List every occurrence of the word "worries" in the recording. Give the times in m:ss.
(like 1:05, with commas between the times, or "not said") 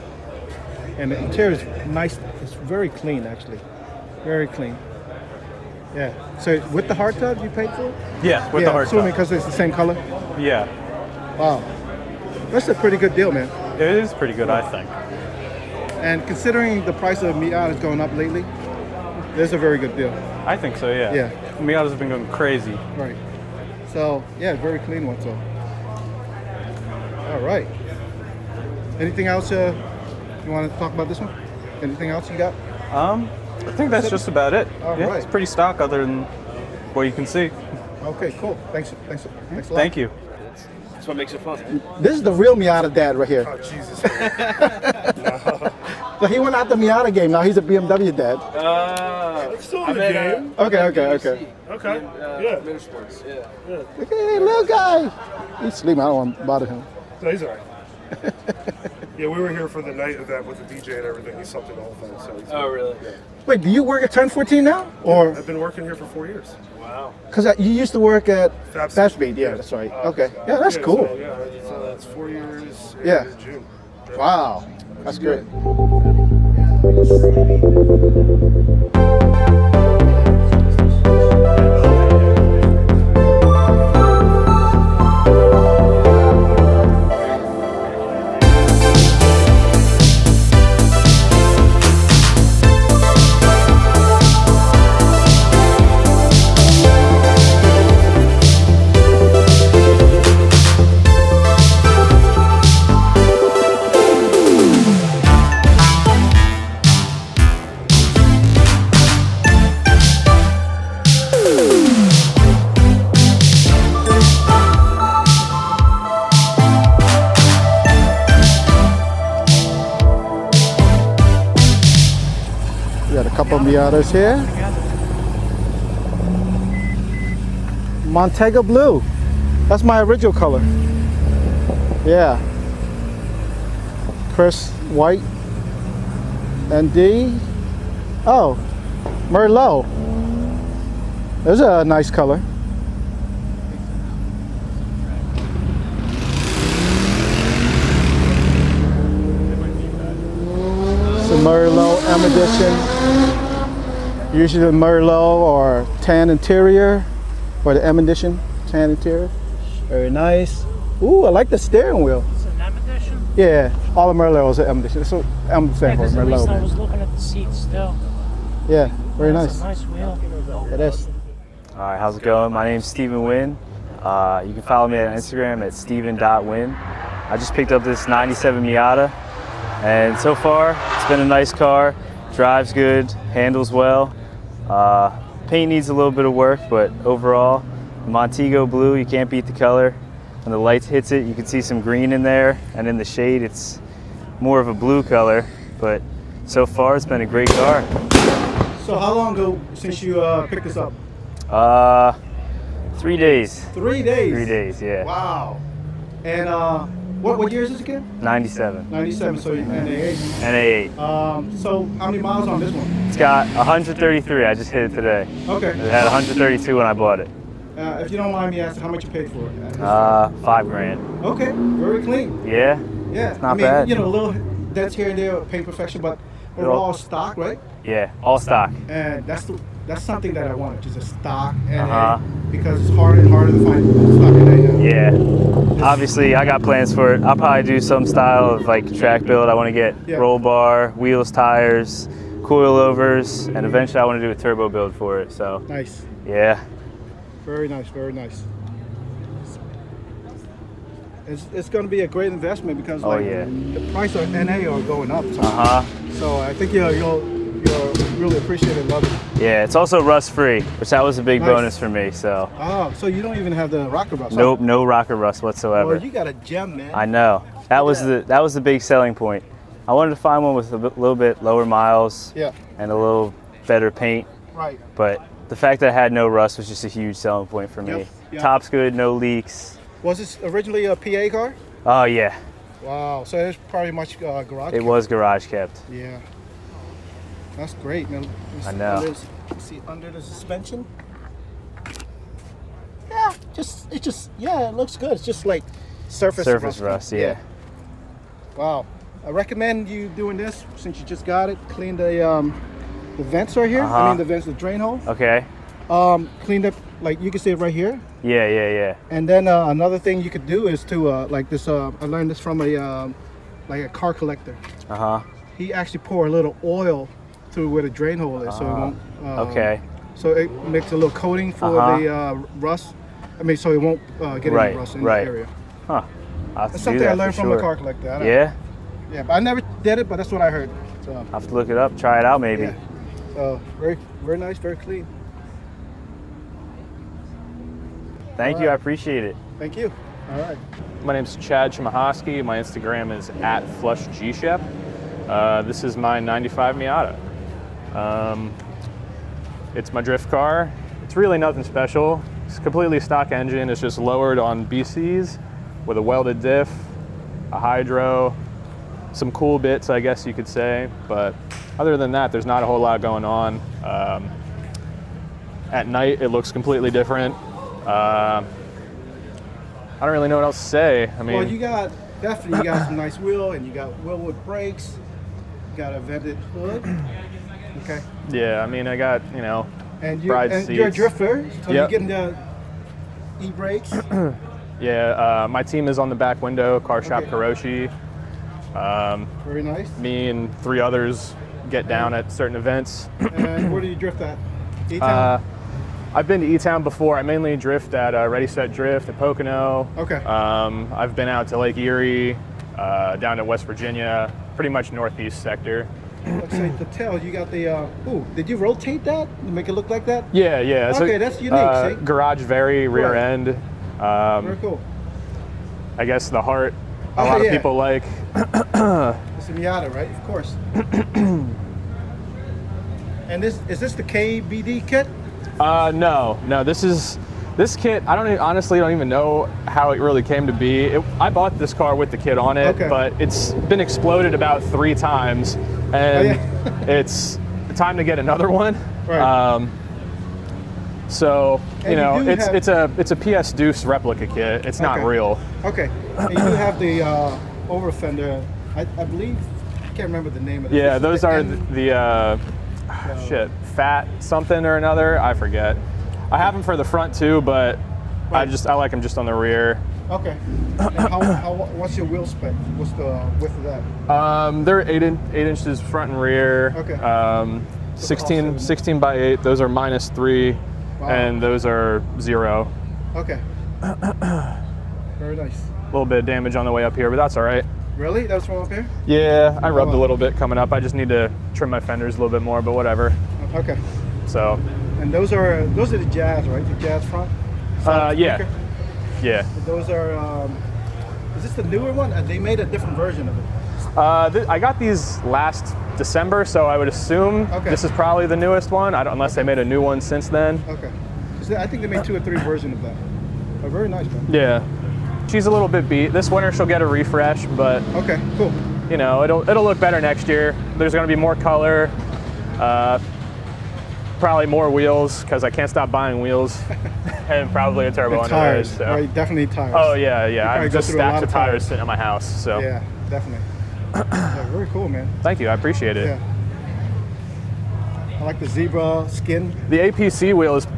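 not said.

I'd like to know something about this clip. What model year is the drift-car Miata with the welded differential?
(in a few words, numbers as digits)
95.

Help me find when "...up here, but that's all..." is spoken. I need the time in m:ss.
7:56.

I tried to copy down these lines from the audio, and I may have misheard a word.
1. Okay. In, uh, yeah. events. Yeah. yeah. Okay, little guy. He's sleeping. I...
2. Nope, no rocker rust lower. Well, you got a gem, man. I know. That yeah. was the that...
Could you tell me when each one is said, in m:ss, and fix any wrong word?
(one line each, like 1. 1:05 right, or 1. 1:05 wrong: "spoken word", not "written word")
1. 0:51 wrong: "sports", not "events"
2. 4:24 wrong: "whatsoever", not "lower".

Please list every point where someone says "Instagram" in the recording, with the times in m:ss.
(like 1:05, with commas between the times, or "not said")
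2:55, 5:42.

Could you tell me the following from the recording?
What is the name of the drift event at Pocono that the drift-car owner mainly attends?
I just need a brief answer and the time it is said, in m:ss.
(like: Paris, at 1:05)
Ready Set Drift, at 6:38.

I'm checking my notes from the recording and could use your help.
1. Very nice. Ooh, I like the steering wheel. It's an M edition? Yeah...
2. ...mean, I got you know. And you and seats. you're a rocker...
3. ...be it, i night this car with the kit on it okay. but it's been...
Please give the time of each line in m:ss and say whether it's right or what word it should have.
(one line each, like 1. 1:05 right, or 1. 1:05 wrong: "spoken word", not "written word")
1. 2:39 right
2. 6:18 wrong: "drifter", not "rocker"
3. 7:10 wrong: "bought", not "night".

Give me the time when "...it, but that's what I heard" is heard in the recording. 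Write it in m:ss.
5:30.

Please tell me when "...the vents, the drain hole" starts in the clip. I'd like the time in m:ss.
5:04.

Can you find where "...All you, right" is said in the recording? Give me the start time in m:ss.
5:38.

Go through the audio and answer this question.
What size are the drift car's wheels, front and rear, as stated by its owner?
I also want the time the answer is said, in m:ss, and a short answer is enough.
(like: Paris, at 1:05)
16 by 8, at 7:48.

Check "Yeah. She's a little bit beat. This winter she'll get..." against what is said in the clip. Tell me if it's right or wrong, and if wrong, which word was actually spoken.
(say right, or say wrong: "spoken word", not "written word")
right.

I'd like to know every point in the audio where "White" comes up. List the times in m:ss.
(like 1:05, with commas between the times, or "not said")
2:14.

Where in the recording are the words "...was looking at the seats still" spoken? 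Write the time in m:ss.
2:46.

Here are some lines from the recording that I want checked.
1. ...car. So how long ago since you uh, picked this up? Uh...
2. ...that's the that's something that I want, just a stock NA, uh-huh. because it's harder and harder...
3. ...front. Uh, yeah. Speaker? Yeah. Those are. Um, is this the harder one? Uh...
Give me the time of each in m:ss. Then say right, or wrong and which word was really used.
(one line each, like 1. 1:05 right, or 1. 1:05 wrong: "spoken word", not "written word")
1. 3:17 right
2. 3:49 right
3. 8:07 wrong: "newer", not "harder".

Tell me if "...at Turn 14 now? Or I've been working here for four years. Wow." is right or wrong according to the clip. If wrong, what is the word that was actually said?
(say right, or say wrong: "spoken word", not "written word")
right.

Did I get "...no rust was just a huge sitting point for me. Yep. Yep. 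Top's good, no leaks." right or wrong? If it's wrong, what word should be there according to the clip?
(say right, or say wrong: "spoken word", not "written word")
wrong: "selling", not "sitting".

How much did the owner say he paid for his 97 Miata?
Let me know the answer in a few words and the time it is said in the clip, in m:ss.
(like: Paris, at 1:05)
5 grand, at 3:40.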